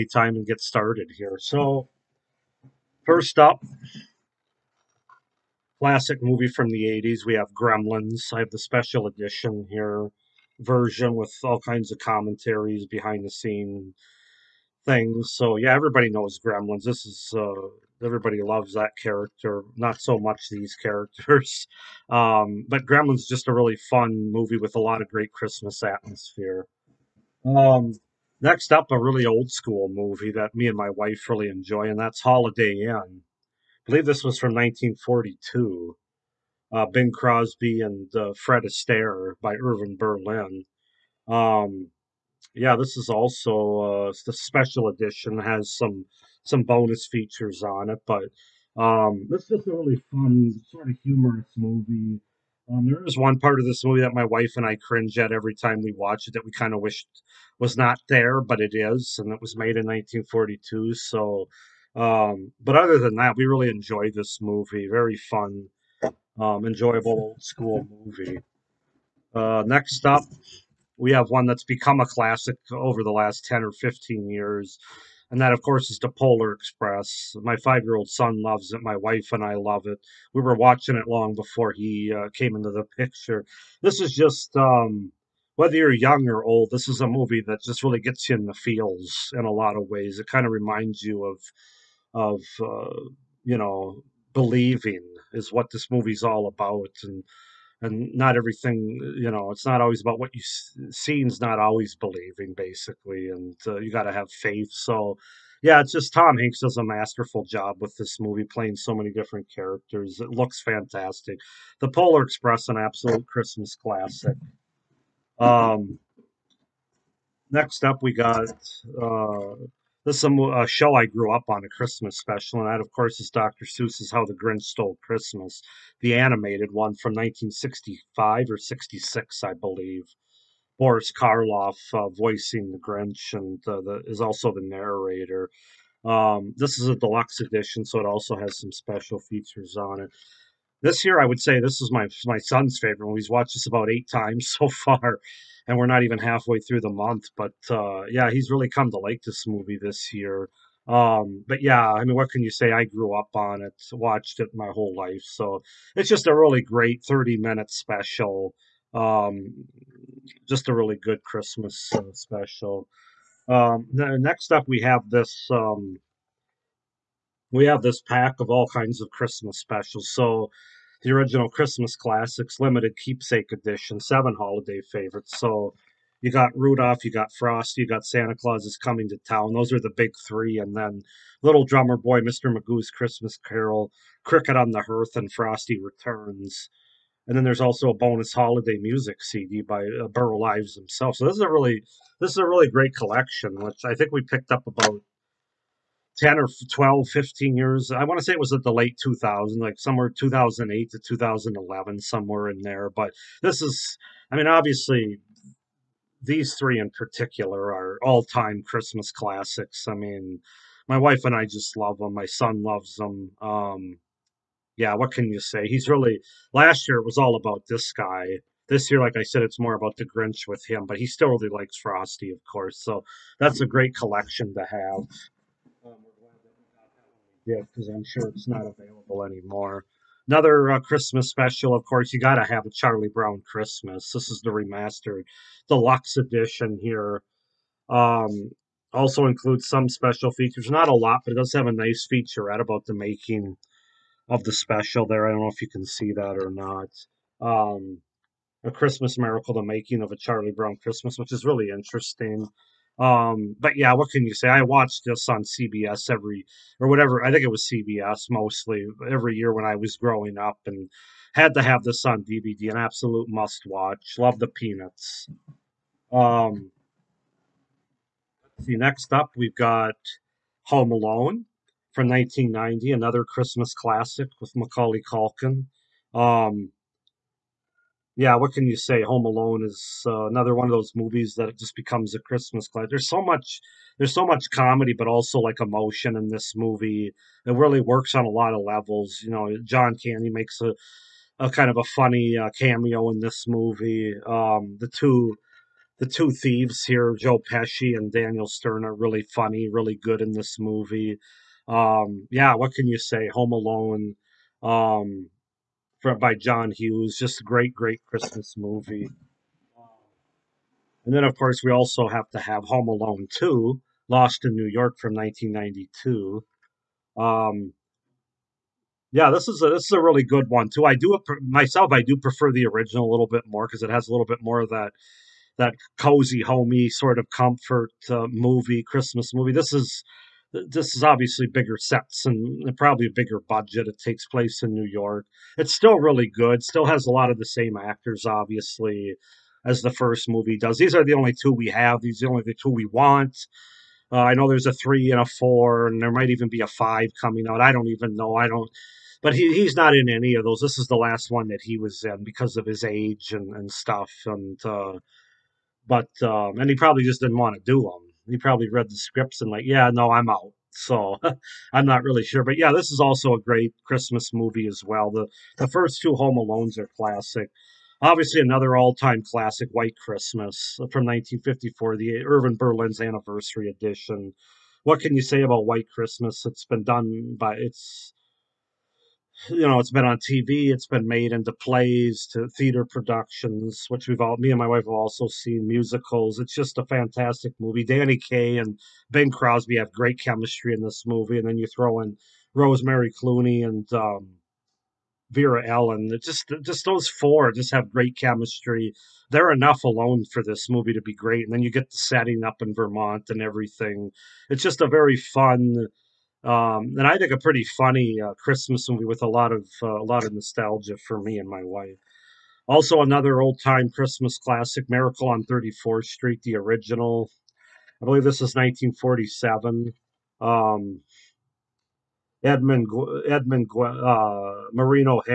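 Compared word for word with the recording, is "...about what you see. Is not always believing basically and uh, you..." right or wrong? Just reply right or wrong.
right.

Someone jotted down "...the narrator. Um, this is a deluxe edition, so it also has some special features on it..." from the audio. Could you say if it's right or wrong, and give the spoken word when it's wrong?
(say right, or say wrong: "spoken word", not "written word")
right.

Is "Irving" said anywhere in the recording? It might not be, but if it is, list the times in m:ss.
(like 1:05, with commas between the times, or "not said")
0:39, 6:12.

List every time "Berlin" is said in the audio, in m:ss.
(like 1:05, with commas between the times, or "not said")
0:39, 6:12.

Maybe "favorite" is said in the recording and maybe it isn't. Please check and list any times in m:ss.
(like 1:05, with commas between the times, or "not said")
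2:22, 2:54.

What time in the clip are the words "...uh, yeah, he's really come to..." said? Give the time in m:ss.
2:27.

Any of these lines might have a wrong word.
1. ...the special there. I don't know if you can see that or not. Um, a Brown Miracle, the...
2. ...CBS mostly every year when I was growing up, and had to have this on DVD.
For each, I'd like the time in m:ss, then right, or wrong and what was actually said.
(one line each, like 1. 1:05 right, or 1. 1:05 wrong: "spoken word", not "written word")
1. 4:04 wrong: "Christmas", not "Brown"
2. 4:17 right.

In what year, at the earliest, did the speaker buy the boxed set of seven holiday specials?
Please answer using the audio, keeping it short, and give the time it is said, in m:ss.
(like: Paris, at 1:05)
2008, at 3:20.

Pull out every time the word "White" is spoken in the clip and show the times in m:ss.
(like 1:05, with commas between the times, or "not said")
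6:09, 6:15.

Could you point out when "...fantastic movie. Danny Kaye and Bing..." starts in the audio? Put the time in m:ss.
6:26.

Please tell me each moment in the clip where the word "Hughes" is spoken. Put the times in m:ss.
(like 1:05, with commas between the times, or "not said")
5:06.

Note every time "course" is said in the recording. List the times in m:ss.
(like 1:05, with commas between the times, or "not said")
1:15, 2:02, 3:42, 3:51, 5:11.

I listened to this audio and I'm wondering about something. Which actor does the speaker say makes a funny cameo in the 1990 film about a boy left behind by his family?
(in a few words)
John Candy.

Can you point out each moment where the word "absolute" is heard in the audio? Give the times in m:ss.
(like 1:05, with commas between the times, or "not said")
1:52, 4:22.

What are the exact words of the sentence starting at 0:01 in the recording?
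So, first up, classic movie from the 80s.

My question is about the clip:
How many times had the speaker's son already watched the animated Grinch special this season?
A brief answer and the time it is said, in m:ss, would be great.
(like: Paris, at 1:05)
8, at 2:23.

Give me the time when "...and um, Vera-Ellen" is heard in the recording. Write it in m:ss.
6:33.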